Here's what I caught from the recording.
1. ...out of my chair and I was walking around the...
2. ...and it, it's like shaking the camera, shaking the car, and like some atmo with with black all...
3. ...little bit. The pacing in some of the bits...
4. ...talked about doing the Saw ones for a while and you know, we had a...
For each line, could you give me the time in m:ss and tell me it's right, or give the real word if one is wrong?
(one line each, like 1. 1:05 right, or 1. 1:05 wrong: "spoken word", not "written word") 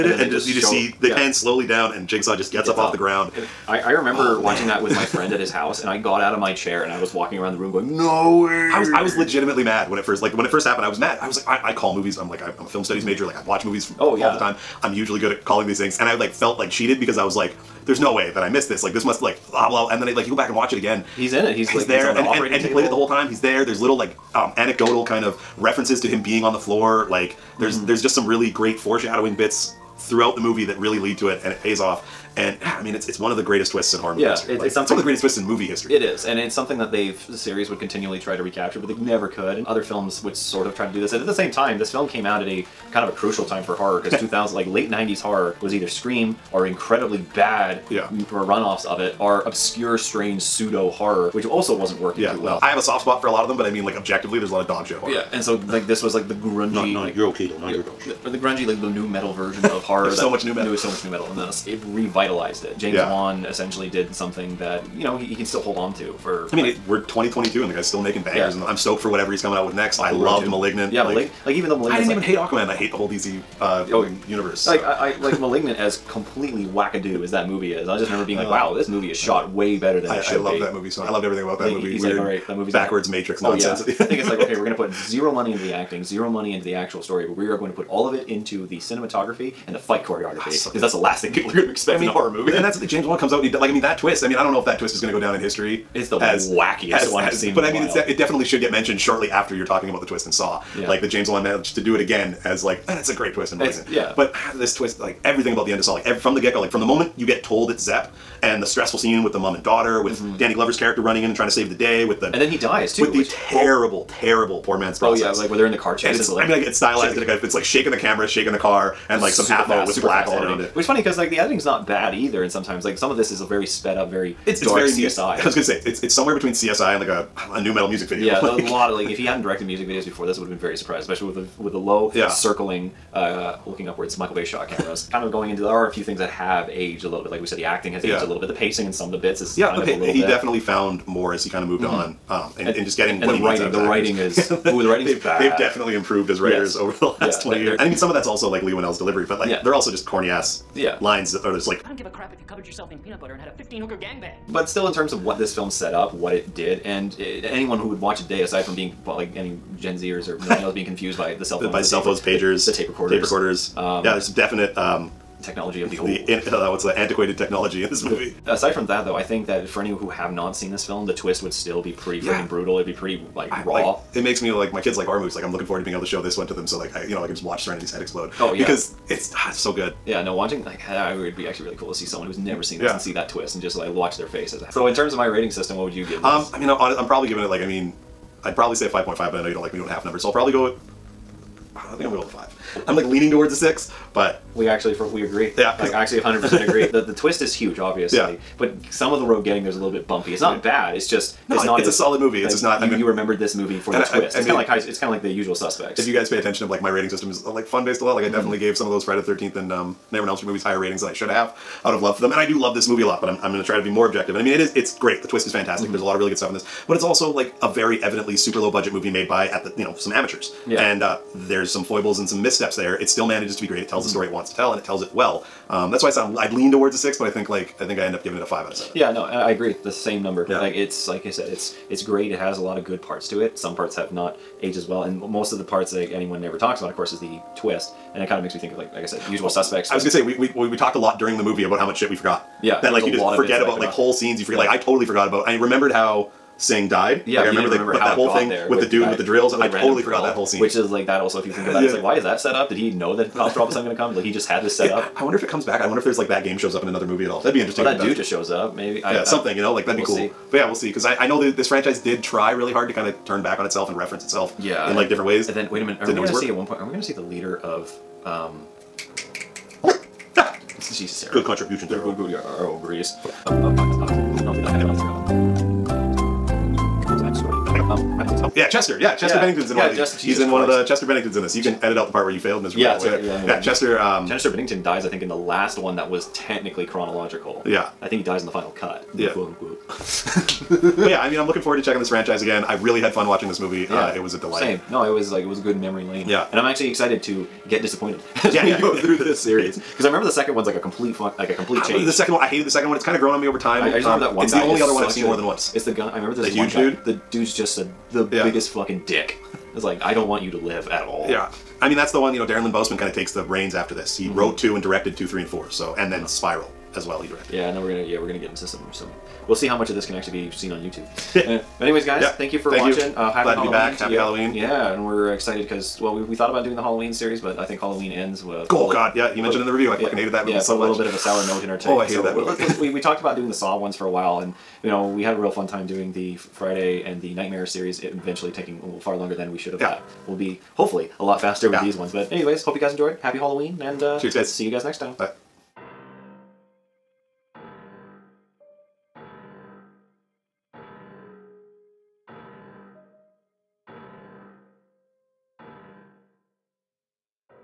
1. 0:06 right
2. 1:57 right
3. 2:18 right
4. 5:33 right.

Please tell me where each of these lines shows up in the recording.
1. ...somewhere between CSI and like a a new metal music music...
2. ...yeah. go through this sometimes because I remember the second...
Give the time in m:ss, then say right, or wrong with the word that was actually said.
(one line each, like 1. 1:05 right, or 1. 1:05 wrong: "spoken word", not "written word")
1. 2:06 right
2. 4:58 wrong: "series", not "sometimes".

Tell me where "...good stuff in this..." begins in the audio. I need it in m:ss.
3:36.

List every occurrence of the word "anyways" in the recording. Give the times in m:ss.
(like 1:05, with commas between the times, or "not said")
5:21, 5:42.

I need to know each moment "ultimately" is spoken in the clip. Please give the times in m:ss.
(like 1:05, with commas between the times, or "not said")
not said.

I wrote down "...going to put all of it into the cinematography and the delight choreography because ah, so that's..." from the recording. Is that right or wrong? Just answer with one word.
wrong.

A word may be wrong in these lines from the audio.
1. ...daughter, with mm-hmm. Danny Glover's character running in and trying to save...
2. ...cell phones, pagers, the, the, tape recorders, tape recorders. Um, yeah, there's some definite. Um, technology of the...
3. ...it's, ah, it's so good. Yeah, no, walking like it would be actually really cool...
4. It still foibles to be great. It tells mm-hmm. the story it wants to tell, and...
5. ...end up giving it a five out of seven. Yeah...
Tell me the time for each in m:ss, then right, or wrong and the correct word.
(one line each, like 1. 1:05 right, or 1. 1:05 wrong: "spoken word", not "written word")
1. 1:49 right
2. 2:41 right
3. 2:59 wrong: "watching", not "walking"
4. 3:42 wrong: "manages", not "foibles"
5. 3:48 right.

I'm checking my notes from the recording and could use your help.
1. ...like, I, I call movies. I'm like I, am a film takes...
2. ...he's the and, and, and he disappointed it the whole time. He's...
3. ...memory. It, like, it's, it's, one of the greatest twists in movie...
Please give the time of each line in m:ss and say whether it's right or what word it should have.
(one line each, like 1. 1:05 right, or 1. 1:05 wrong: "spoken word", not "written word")
1. 0:11 wrong: "studies", not "takes"
2. 0:22 wrong: "played", not "disappointed"
3. 0:34 wrong: "history", not "memory".